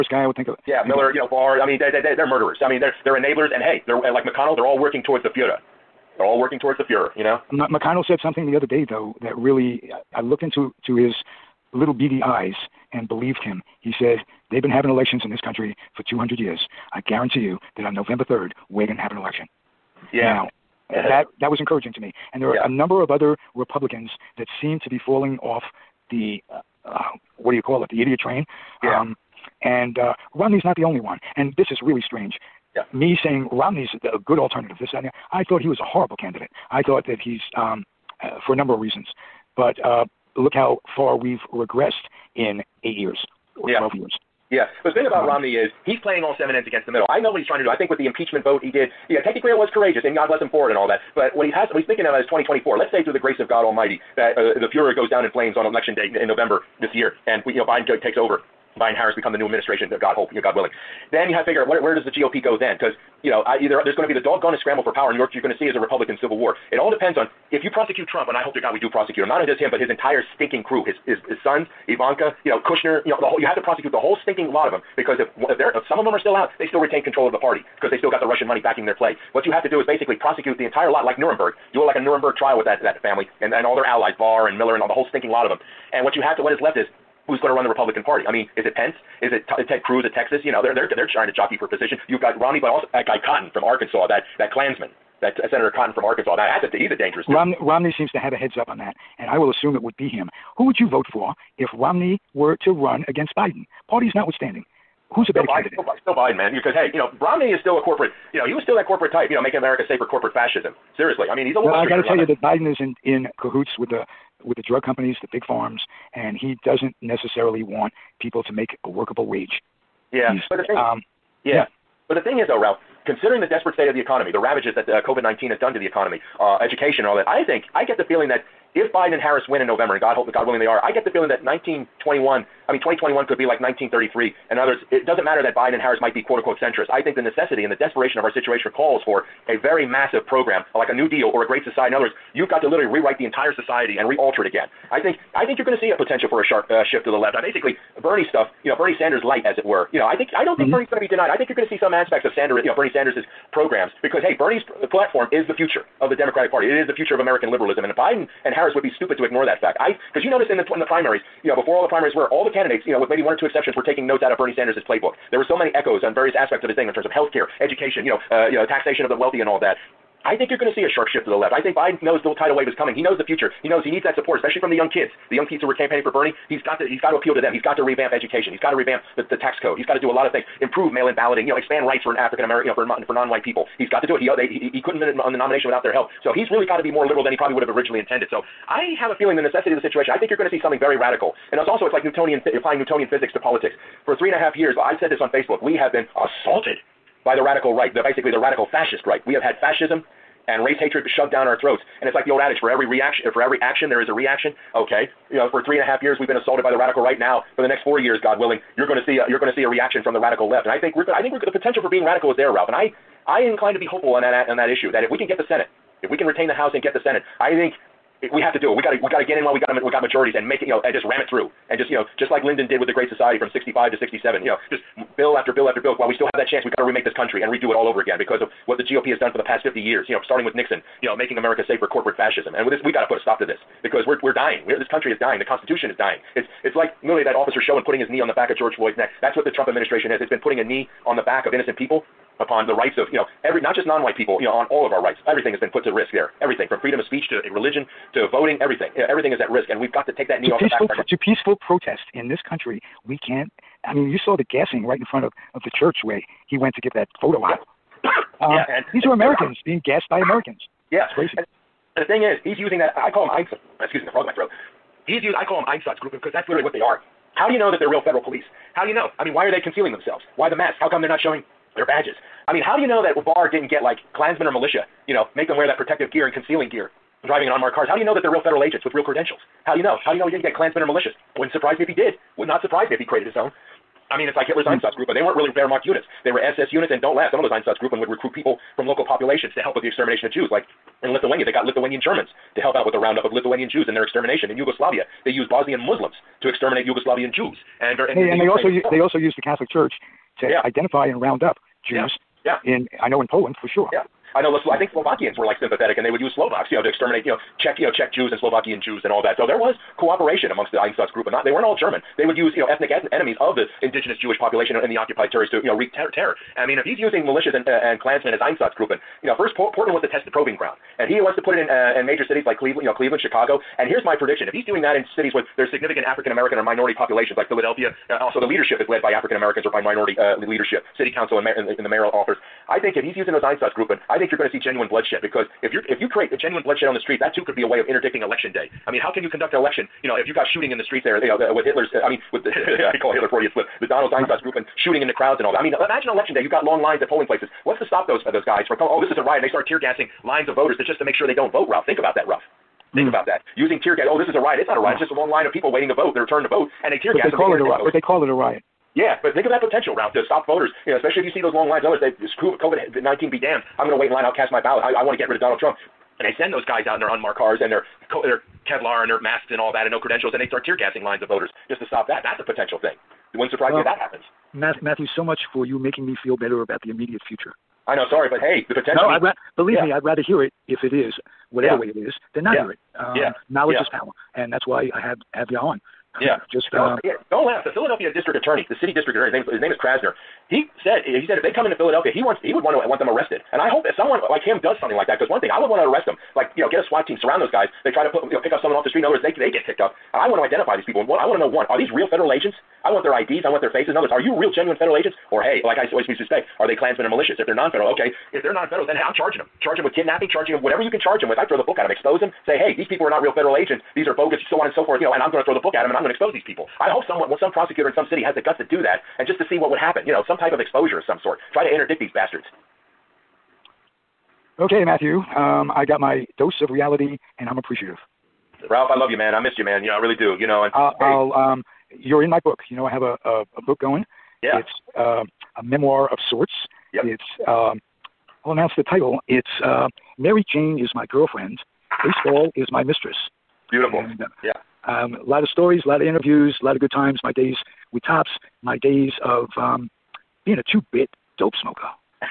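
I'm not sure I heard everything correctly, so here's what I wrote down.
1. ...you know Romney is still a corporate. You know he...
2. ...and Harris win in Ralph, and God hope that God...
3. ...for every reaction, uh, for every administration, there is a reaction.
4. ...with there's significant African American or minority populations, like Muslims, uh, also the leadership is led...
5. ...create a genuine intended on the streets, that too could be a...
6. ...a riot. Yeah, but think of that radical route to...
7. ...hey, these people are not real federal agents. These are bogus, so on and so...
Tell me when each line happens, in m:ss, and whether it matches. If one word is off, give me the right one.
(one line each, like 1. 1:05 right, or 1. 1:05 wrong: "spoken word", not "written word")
1. 1:46 right
2. 2:09 wrong: "November", not "Ralph"
3. 3:22 wrong: "action", not "administration"
4. 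5:25 wrong: "Philadelphia", not "Muslims"
5. 5:36 wrong: "bloodshed", not "intended"
6. 5:58 wrong: "potential", not "radical"
7. 6:52 right.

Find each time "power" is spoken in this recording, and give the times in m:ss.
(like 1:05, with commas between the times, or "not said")
1:04, 6:23.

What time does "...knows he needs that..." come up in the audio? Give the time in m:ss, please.
2:53.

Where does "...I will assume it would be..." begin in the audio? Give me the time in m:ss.
1:39.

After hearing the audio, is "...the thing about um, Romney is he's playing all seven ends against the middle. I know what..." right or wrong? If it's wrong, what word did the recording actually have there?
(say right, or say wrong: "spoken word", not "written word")
right.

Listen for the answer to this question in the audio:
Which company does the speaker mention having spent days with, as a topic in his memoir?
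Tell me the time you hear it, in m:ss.
7:28.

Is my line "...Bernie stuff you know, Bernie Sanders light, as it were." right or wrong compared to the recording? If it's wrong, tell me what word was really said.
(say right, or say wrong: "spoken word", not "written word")
right.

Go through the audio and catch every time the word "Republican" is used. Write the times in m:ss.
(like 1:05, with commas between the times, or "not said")
0:23, 1:05, 1:27.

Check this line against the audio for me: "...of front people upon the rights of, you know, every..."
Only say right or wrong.
wrong.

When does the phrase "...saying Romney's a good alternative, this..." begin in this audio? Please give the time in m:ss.
0:33.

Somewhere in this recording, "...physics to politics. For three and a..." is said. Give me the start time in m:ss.
3:13.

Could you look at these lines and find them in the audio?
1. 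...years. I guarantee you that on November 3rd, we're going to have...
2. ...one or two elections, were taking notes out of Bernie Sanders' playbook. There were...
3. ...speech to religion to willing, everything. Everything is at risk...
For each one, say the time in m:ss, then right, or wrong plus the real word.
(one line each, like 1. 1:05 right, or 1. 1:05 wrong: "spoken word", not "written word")
1. 0:16 right
2. 2:43 wrong: "exceptions", not "elections"
3. 4:07 wrong: "voting", not "willing".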